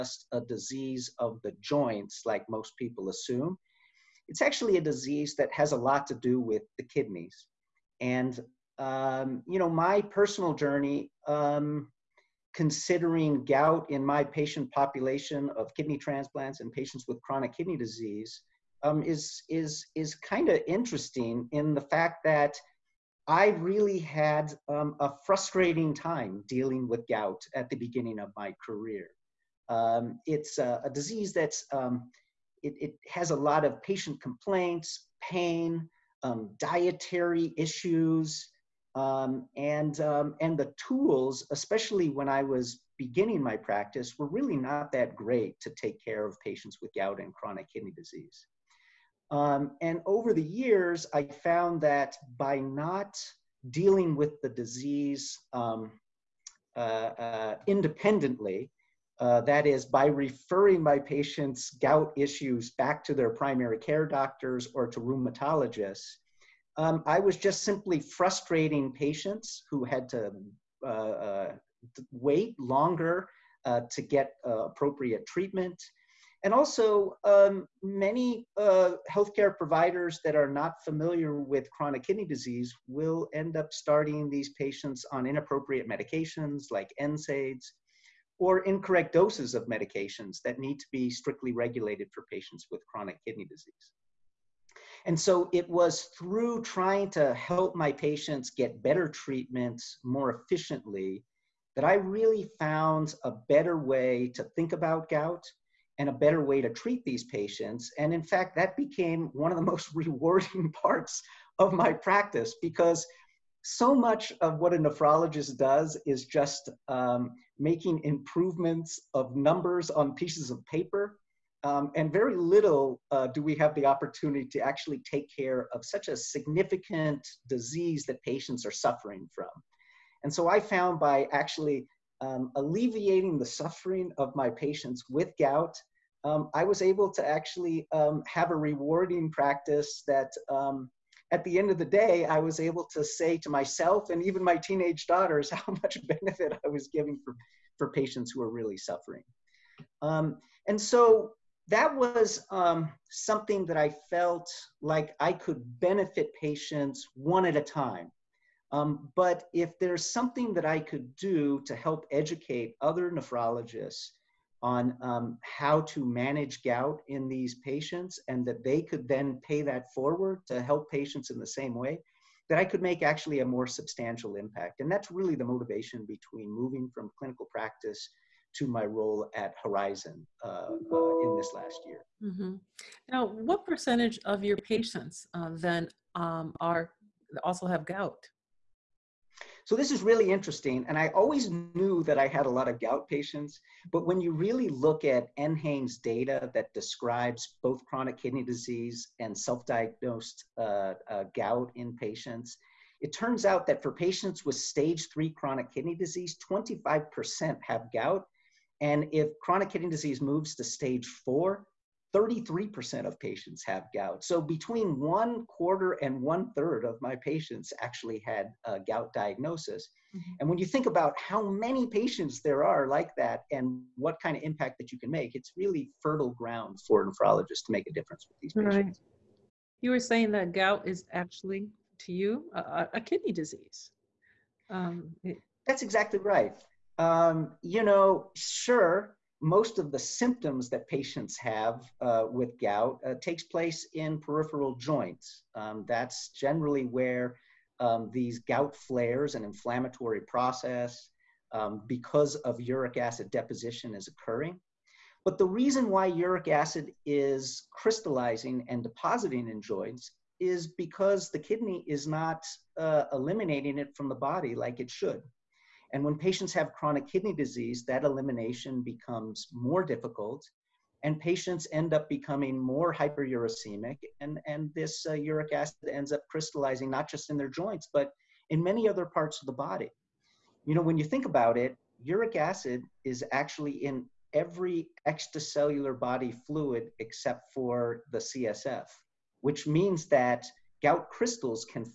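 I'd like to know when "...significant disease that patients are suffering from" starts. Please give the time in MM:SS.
02:06.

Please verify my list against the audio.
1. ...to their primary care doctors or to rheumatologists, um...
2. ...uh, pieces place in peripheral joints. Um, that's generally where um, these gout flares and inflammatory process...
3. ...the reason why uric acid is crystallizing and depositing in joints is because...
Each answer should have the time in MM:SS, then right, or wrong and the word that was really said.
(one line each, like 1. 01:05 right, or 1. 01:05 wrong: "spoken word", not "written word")
1. 01:03 right
2. 04:03 wrong: "takes", not "pieces"
3. 04:15 right.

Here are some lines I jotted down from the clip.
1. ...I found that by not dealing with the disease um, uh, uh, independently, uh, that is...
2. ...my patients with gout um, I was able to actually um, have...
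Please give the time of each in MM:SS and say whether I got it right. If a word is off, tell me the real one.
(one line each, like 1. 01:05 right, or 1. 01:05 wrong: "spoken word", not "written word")
1. 00:51 right
2. 02:14 right.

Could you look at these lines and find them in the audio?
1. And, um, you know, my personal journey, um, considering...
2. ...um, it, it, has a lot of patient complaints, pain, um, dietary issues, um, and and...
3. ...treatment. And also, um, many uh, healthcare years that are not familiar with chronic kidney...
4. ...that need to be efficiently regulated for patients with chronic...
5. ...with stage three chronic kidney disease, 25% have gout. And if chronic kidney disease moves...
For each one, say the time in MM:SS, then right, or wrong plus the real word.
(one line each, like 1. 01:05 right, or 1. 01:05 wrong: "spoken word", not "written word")
1. 00:07 right
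2. 00:31 right
3. 01:15 wrong: "providers", not "years"
4. 01:30 wrong: "strictly", not "efficiently"
5. 03:24 right.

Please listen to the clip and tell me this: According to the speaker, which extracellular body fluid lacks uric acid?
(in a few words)
CSF.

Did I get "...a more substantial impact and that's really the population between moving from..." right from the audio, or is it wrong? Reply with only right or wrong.
wrong.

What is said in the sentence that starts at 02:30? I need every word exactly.
Um, and so that was um, something that I felt like I could benefit patients one at a time.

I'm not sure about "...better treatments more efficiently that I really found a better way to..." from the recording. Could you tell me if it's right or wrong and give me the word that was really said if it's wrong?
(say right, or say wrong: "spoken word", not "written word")
right.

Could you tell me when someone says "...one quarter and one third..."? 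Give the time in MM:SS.
03:34.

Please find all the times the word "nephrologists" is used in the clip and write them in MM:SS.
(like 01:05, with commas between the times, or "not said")
01:54, 02:43, 03:47.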